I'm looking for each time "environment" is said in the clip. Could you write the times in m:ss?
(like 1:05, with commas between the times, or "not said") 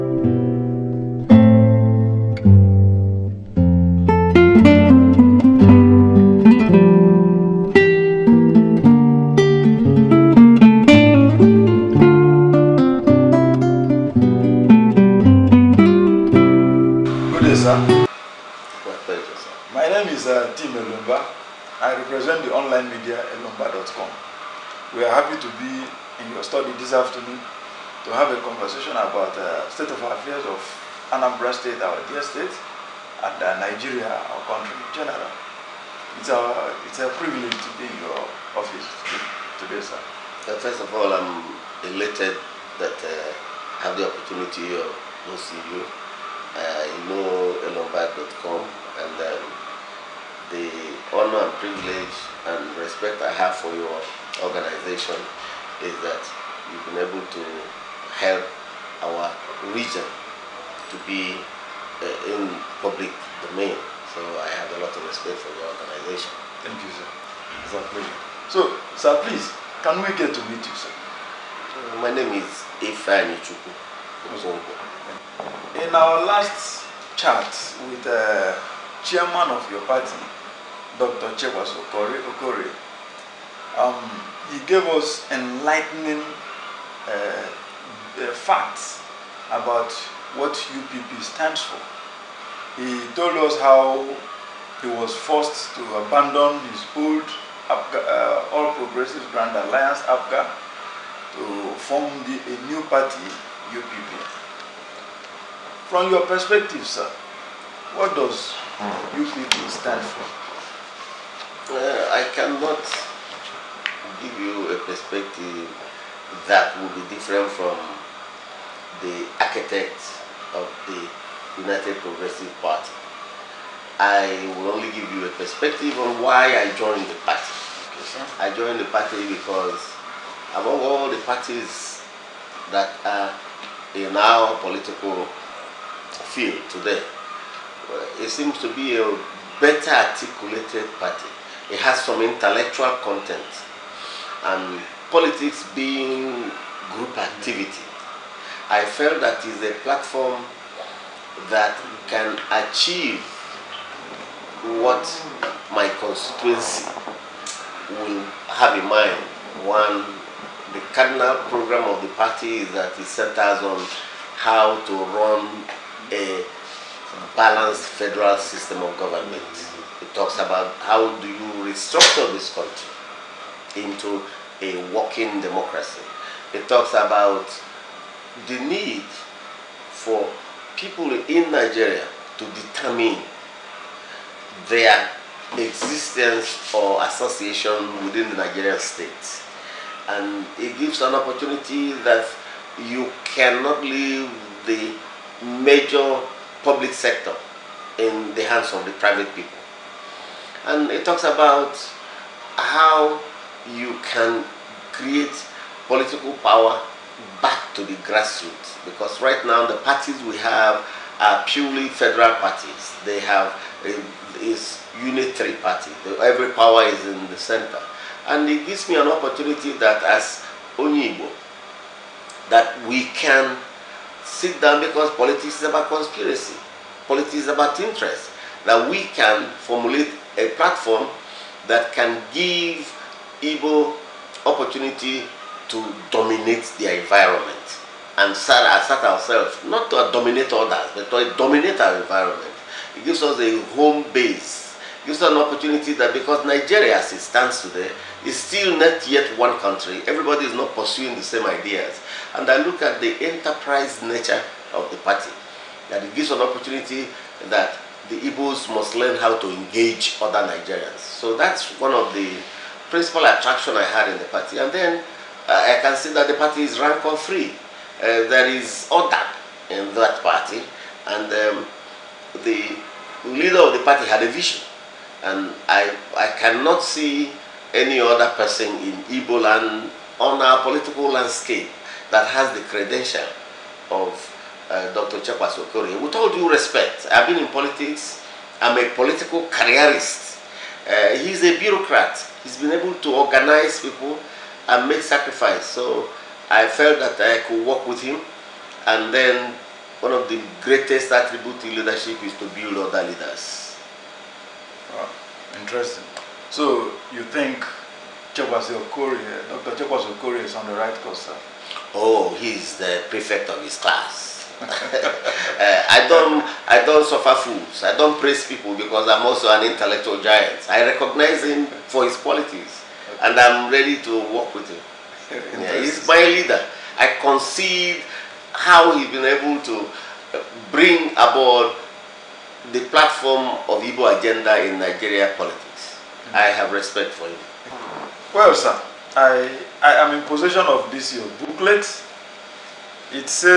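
3:56, 4:01.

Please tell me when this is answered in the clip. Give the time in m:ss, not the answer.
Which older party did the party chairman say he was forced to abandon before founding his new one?
1:38.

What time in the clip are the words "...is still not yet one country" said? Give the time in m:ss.
4:08.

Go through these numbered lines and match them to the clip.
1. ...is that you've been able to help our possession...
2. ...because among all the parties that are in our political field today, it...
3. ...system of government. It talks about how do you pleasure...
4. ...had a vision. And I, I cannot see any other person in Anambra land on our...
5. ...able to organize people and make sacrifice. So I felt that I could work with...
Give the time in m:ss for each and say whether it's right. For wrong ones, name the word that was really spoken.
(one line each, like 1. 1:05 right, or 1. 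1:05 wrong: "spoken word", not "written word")
1. 0:55 wrong: "region", not "possession"
2. 2:09 right
3. 2:48 wrong: "restructure", not "pleasure"
4. 4:34 wrong: "Igbo", not "Anambra"
5. 4:52 right.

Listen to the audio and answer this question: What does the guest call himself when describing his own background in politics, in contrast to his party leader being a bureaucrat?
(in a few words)
political careerist.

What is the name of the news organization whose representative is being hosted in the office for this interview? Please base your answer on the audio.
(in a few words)
elombar.com.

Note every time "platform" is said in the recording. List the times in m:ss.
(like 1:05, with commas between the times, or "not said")
2:29, 3:50, 5:32.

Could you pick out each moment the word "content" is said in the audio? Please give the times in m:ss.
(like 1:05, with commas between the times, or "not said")
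2:23.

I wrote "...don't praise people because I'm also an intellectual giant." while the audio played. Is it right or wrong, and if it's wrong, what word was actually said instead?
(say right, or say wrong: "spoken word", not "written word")
right.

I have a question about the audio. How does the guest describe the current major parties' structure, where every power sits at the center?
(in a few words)
unitary party.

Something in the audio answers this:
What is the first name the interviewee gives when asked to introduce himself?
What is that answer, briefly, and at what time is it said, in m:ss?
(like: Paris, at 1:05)
Ifeanyichukwu, at 1:12.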